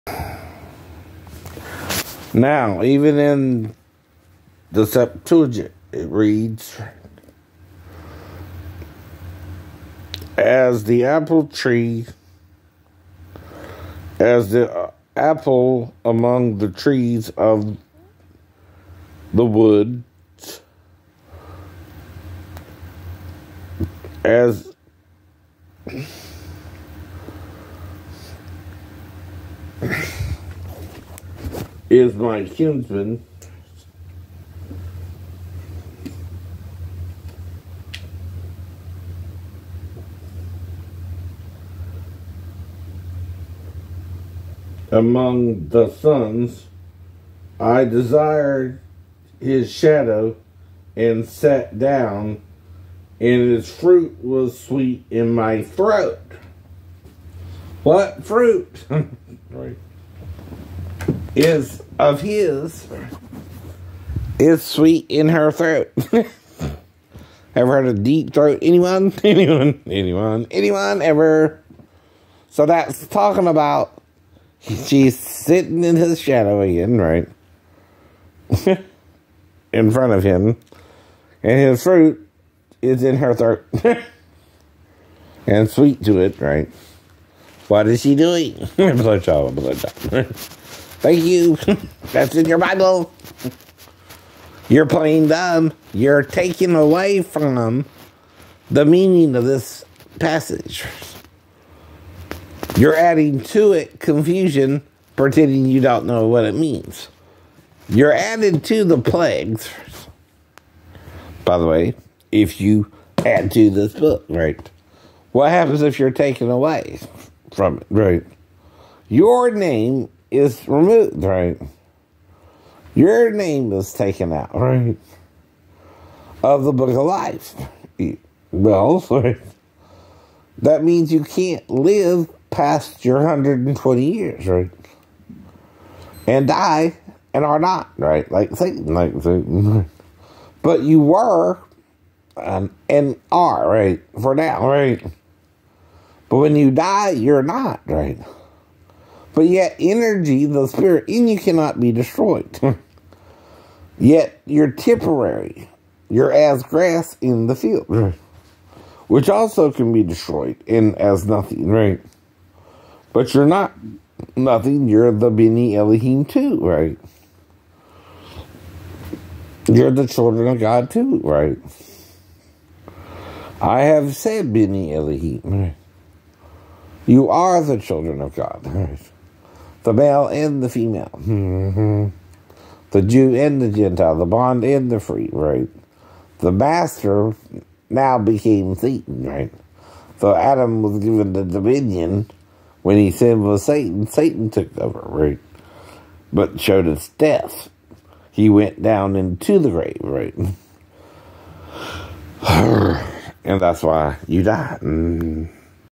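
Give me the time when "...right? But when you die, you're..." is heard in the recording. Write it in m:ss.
2:24.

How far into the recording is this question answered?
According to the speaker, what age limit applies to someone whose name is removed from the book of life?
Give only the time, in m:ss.
2:13.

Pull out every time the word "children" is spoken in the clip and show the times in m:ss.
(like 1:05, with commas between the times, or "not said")
2:50, 2:57.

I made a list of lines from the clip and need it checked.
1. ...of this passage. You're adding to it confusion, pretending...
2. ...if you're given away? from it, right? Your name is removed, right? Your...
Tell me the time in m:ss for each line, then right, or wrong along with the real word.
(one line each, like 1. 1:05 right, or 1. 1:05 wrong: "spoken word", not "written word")
1. 1:39 right
2. 1:55 wrong: "taken", not "given".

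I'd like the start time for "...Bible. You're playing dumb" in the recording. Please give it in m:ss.
1:32.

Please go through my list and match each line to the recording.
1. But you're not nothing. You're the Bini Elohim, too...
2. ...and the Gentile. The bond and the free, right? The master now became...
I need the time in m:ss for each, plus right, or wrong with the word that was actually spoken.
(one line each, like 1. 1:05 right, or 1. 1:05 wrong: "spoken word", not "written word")
1. 2:43 right
2. 3:03 right.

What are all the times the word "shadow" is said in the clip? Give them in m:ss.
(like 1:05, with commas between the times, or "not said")
0:49, 1:16.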